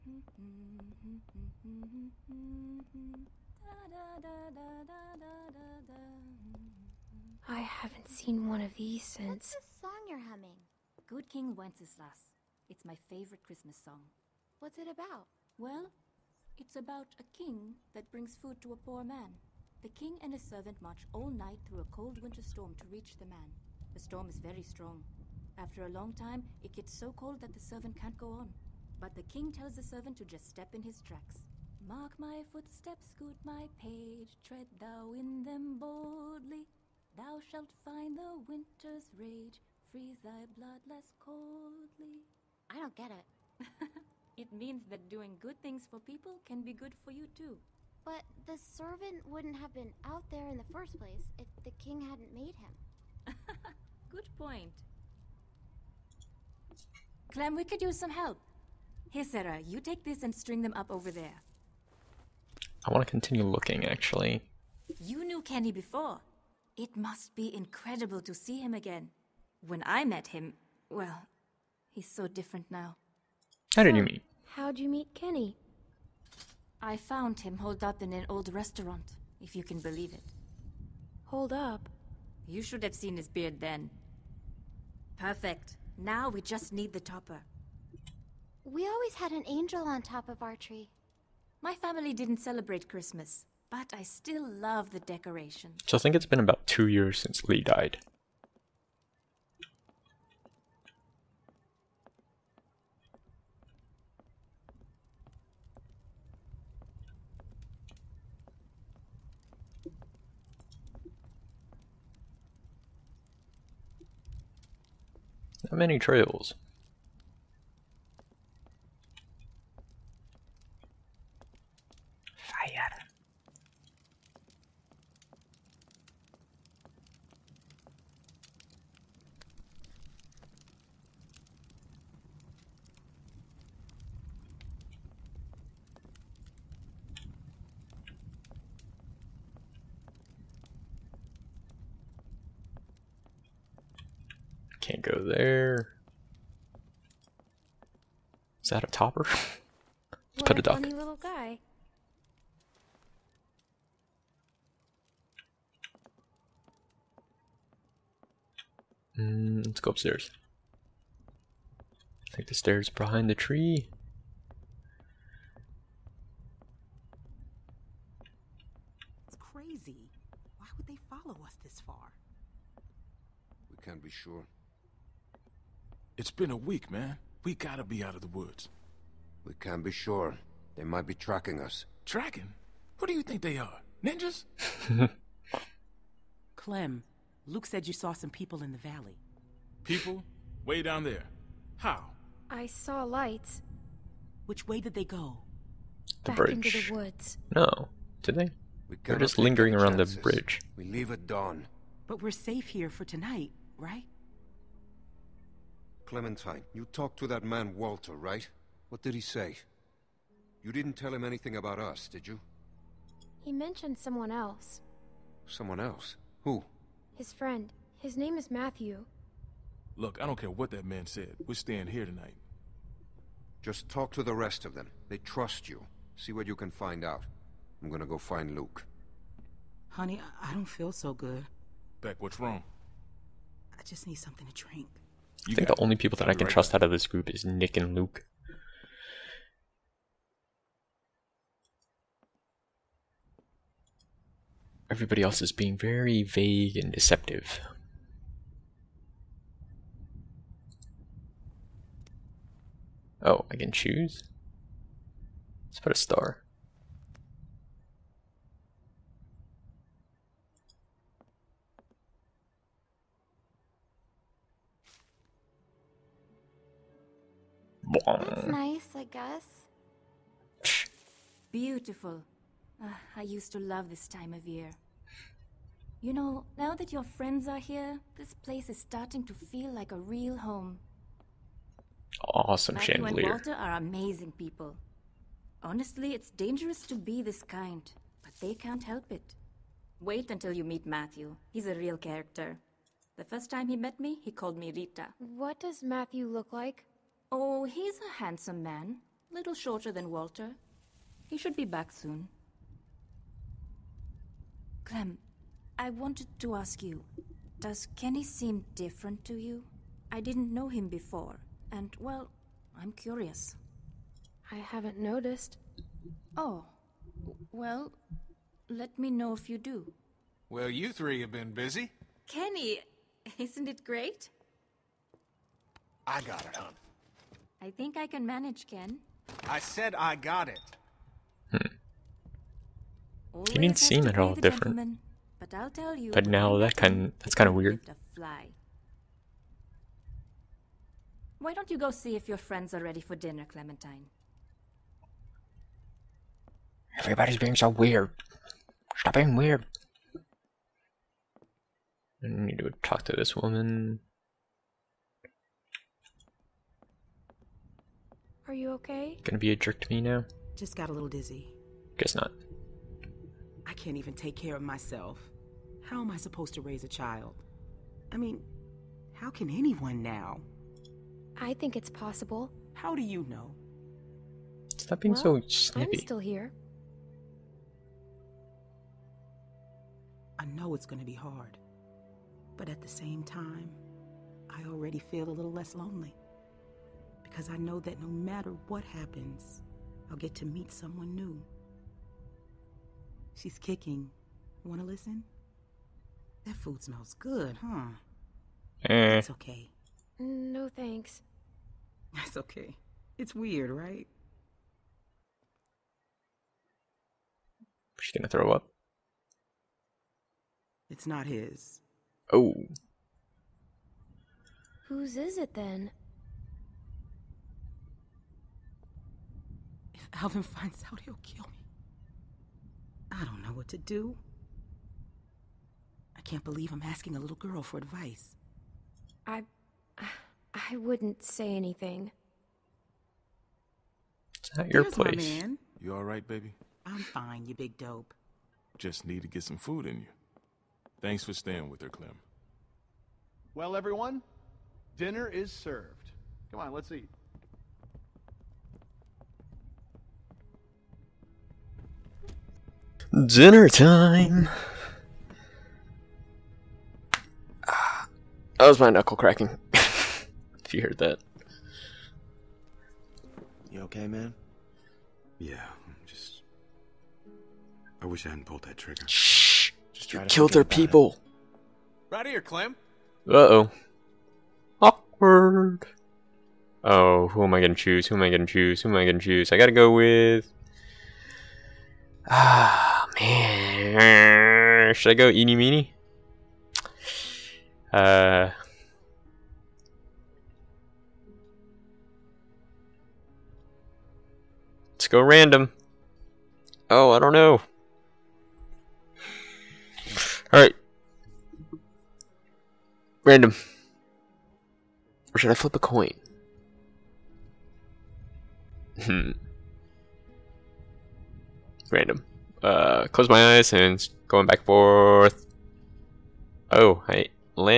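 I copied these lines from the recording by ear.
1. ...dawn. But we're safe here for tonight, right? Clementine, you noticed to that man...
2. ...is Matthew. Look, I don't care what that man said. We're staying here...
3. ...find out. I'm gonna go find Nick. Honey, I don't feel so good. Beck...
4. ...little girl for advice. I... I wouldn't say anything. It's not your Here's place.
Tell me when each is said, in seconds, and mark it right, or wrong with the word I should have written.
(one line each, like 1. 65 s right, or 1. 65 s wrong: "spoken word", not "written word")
1. 201 s wrong: "talked", not "noticed"
2. 218 s right
3. 226 s wrong: "Luke", not "Nick"
4. 427 s right.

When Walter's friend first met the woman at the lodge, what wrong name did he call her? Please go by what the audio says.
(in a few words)
Rita.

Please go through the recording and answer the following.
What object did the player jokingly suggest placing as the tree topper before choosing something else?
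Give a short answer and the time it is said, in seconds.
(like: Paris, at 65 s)
A duck, at 150 s.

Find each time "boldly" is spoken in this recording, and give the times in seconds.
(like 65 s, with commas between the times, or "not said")
35 s.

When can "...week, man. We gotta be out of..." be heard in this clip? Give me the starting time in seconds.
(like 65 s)
176 s.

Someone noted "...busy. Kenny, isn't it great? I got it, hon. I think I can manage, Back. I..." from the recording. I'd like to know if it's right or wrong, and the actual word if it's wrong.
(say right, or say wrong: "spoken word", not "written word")
wrong: "Ken", not "Back".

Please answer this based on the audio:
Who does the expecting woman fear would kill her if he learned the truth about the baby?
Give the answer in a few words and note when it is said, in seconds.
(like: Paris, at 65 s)
Alvin, at 420 s.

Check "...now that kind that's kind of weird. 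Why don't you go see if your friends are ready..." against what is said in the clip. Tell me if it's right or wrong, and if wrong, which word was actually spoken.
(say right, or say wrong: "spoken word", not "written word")
right.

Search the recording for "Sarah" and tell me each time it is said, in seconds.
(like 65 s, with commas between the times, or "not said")
59 s.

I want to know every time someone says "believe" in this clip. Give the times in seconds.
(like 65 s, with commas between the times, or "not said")
79 s, 426 s.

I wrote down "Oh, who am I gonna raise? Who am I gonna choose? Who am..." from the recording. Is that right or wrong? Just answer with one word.
wrong.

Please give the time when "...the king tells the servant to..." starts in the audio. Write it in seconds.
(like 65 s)
29 s.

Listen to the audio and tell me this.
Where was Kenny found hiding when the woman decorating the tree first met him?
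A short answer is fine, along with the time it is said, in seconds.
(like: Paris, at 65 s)
An old restaurant, at 78 s.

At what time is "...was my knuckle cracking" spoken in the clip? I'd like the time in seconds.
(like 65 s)
458 s.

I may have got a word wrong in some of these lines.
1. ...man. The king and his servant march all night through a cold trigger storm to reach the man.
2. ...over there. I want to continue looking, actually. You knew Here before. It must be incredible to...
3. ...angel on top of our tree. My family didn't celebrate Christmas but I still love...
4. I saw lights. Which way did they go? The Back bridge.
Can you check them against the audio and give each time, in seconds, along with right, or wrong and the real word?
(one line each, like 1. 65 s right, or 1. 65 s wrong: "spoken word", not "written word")
1. 19 s wrong: "winter", not "trigger"
2. 60 s wrong: "Kenny", not "Here"
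3. 89 s right
4. 192 s right.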